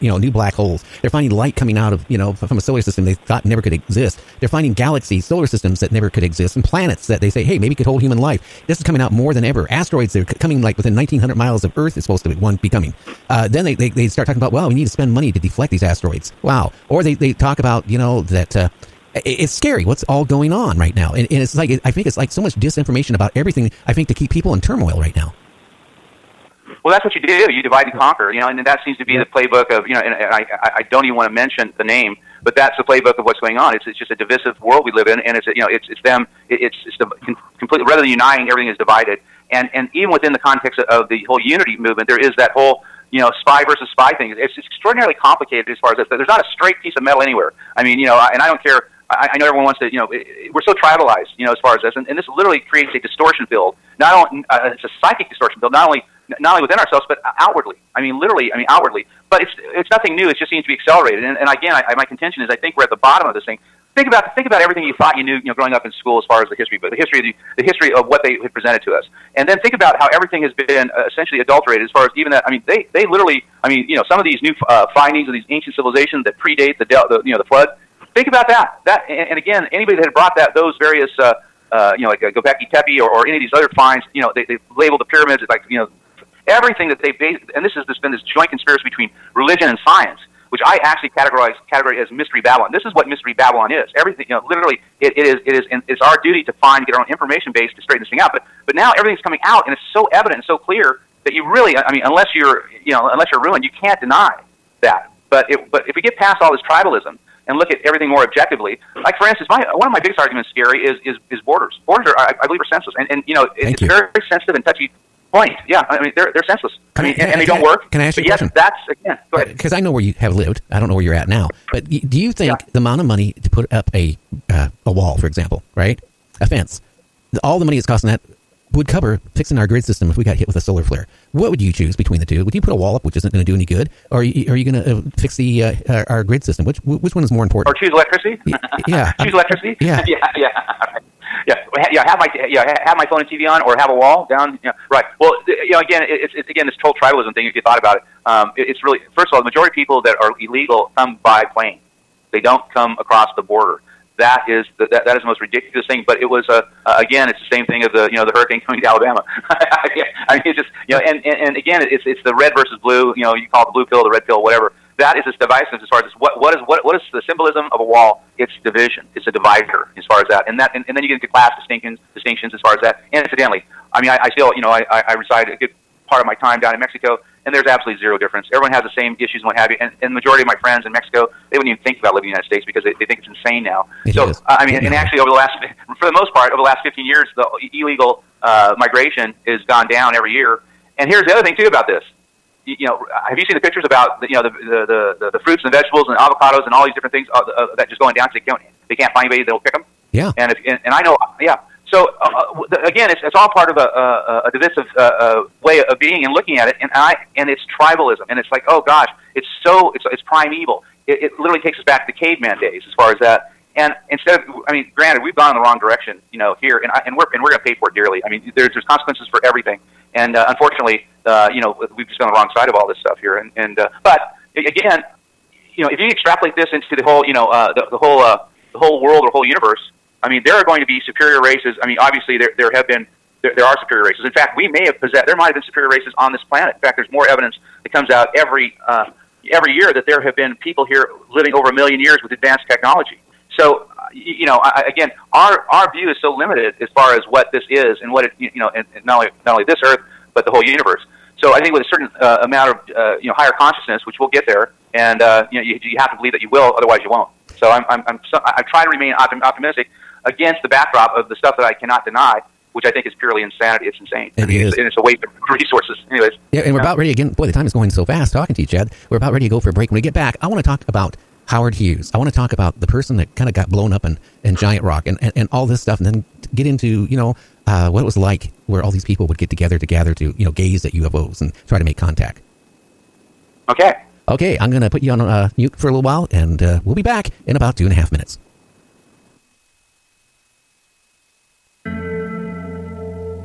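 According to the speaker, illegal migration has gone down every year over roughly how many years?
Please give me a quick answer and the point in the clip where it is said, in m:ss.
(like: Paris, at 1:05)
15 years, at 3:06.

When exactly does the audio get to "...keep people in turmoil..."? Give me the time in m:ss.
0:24.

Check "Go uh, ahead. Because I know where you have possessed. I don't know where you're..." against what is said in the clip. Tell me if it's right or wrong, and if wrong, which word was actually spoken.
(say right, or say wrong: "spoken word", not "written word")
wrong: "lived", not "possessed".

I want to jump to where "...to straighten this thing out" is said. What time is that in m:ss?
1:37.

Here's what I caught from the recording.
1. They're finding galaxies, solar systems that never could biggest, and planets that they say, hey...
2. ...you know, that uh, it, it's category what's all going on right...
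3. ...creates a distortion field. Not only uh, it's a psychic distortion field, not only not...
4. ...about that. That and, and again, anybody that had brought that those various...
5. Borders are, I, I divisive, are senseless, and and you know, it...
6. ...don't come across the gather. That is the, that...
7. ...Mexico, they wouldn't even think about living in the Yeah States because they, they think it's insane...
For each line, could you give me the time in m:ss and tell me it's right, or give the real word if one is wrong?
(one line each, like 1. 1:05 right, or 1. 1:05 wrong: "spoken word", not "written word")
1. 0:04 wrong: "exist", not "biggest"
2. 0:17 wrong: "scary", not "category"
3. 0:52 right
4. 1:18 right
5. 1:51 wrong: "believe", not "divisive"
6. 2:32 wrong: "border", not "gather"
7. 3:00 wrong: "United", not "Yeah".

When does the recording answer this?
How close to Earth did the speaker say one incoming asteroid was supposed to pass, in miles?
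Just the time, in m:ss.
0:10.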